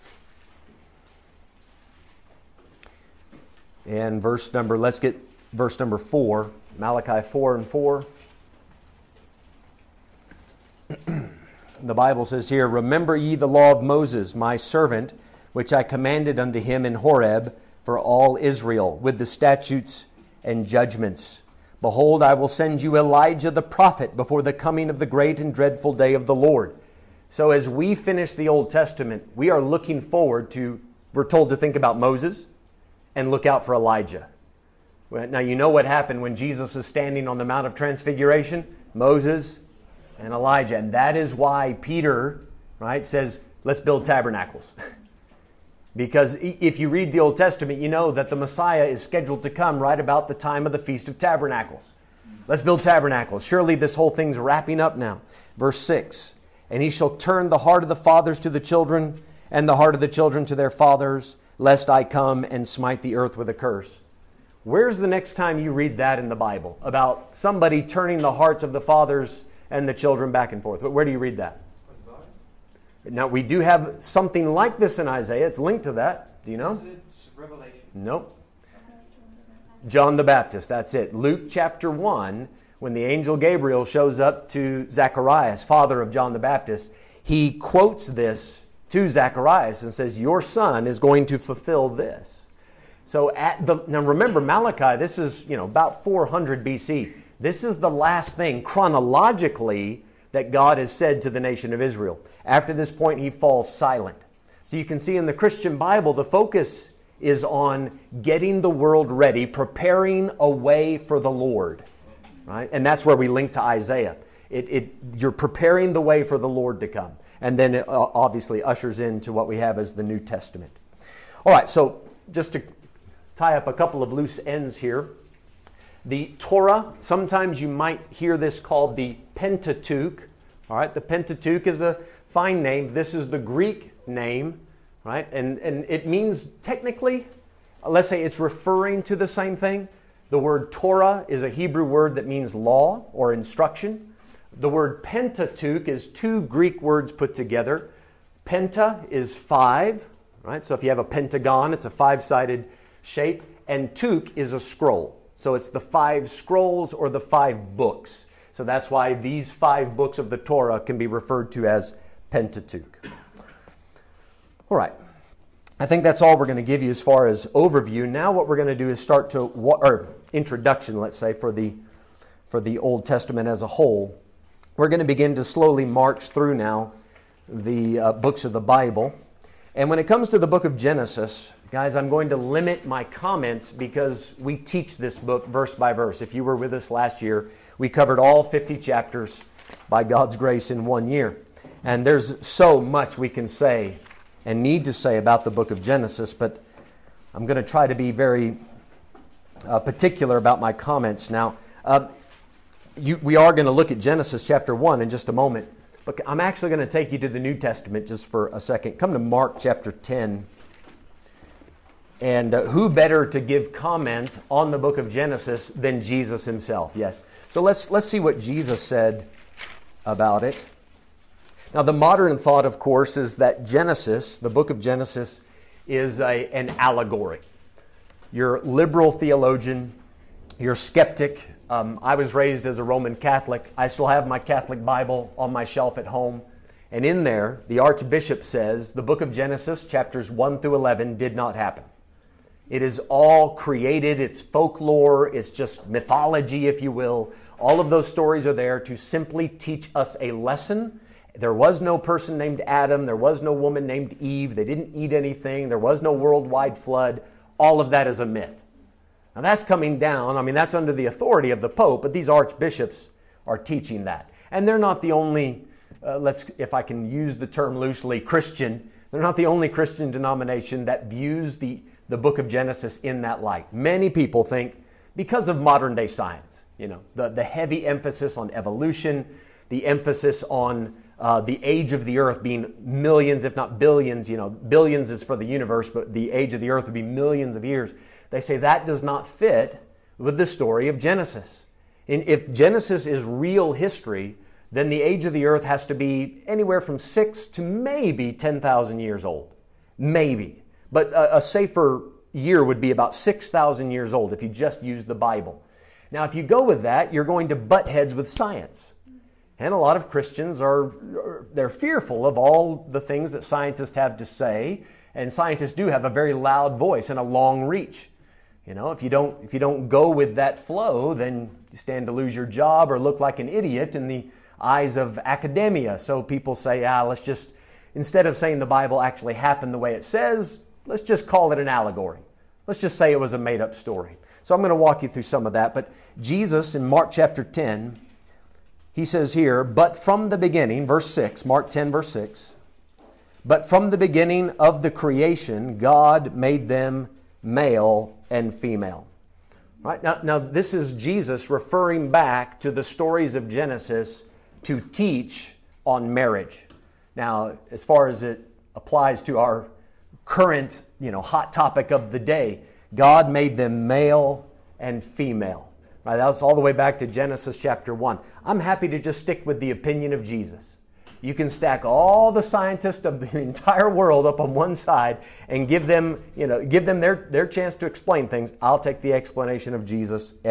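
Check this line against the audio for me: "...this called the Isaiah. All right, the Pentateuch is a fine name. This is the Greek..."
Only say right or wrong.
wrong.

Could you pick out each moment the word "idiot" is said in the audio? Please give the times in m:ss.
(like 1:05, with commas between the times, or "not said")
5:23.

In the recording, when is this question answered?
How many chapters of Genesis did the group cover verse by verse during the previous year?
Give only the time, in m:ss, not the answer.
3:08.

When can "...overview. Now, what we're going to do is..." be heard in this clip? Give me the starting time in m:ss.
2:47.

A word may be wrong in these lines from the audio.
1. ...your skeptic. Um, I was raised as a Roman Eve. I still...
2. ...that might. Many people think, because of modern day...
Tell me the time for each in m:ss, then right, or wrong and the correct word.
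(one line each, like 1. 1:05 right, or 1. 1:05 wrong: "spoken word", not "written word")
1. 3:50 wrong: "Catholic", not "Eve"
2. 4:33 wrong: "light", not "might".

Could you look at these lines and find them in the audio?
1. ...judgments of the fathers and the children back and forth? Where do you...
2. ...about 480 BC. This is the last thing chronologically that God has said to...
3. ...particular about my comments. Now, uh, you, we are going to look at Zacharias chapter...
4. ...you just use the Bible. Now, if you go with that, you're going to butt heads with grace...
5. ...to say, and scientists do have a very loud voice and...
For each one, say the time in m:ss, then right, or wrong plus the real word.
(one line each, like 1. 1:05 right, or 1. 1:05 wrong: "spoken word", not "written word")
1. 1:08 wrong: "hearts", not "judgments"
2. 1:35 wrong: "400", not "480"
3. 3:19 wrong: "Genesis", not "Zacharias"
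4. 5:04 wrong: "science", not "grace"
5. 5:14 right.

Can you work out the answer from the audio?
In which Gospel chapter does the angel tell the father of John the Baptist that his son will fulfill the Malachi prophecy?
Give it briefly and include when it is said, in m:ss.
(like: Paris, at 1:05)
Luke chapter 1, at 1:21.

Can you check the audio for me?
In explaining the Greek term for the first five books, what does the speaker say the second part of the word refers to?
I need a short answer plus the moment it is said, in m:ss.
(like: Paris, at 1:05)
a scroll, at 2:34.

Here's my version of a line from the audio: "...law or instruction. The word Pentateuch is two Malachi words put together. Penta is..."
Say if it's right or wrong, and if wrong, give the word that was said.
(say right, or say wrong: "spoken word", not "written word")
wrong: "Greek", not "Malachi".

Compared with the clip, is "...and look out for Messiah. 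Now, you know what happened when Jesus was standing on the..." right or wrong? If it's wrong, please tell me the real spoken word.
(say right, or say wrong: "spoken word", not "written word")
wrong: "Elijah", not "Messiah".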